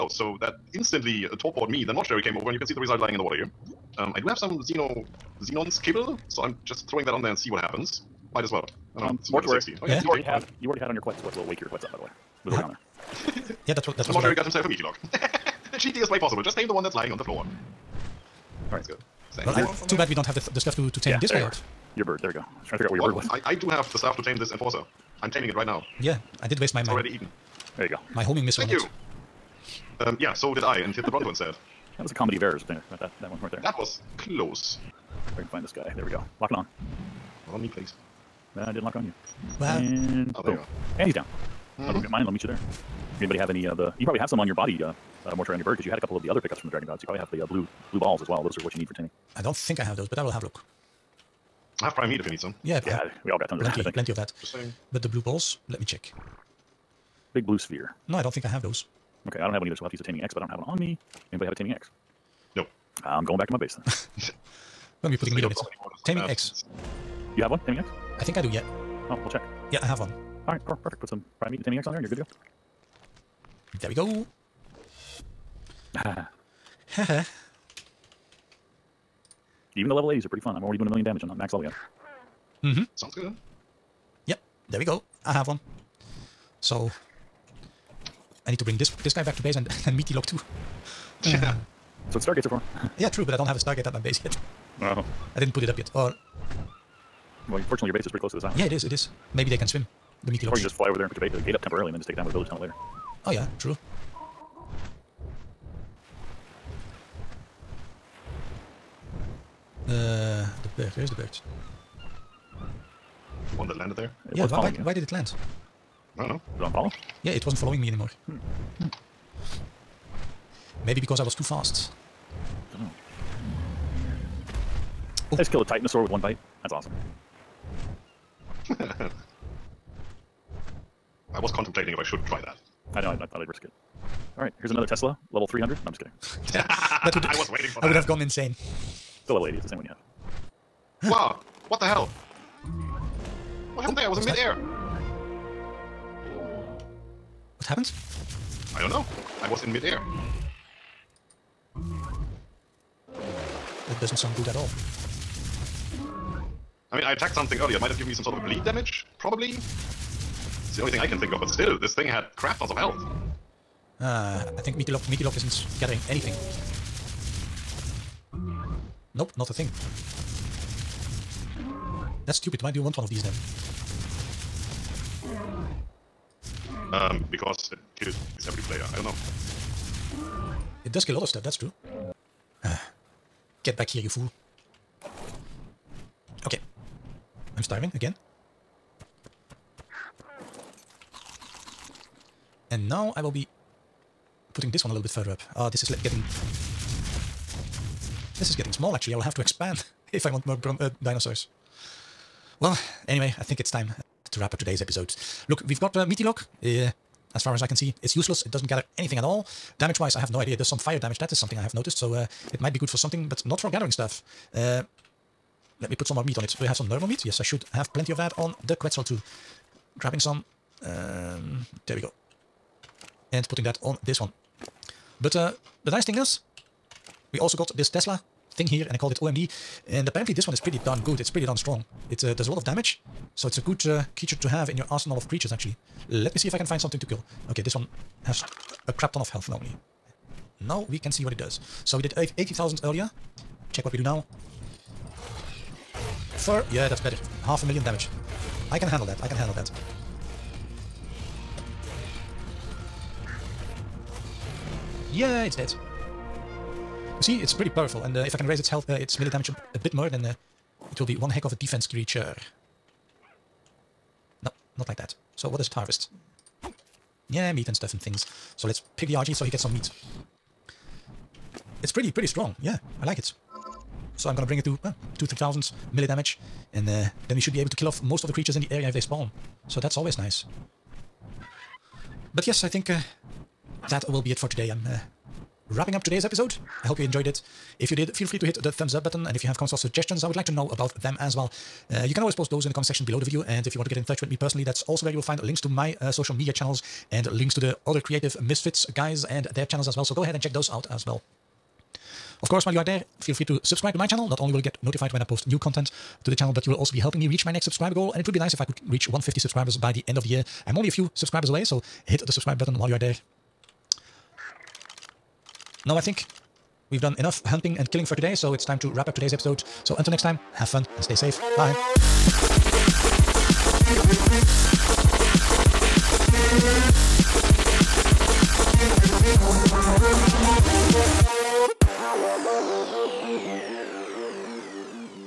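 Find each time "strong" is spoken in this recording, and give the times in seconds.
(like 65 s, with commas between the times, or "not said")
231 s, 272 s.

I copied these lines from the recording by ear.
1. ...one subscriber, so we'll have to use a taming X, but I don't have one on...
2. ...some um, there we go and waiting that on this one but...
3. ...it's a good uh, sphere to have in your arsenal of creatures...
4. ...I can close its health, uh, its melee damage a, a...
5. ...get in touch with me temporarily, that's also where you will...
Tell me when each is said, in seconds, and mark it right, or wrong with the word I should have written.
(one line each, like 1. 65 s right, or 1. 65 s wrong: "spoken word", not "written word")
1. 59 s wrong: "either", not "subscriber"
2. 220 s wrong: "putting", not "waiting"
3. 233 s wrong: "creature", not "sphere"
4. 258 s wrong: "raise", not "close"
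5. 293 s wrong: "personally", not "temporarily".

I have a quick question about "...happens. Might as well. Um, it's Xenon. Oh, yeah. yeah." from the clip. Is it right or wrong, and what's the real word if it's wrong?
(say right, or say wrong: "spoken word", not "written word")
wrong: "Mortuari", not "Xenon".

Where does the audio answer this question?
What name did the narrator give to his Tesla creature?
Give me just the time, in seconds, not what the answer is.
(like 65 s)
229 s.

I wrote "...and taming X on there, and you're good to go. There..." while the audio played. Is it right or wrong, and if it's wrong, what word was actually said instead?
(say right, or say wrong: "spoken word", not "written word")
right.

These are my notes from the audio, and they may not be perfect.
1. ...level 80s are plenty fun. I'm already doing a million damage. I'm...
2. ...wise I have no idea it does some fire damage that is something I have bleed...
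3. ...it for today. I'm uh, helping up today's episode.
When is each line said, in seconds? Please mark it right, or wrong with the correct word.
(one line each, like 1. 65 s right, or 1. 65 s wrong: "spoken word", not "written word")
1. 79 s wrong: "pretty", not "plenty"
2. 209 s wrong: "noticed", not "bleed"
3. 284 s wrong: "wrapping", not "helping".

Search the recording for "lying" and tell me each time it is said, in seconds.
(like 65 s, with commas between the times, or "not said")
2 s, 16 s.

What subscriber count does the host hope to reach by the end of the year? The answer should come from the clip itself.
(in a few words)
150.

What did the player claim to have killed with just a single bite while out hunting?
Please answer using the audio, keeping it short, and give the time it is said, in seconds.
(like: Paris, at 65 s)
titanosaur, at 125 s.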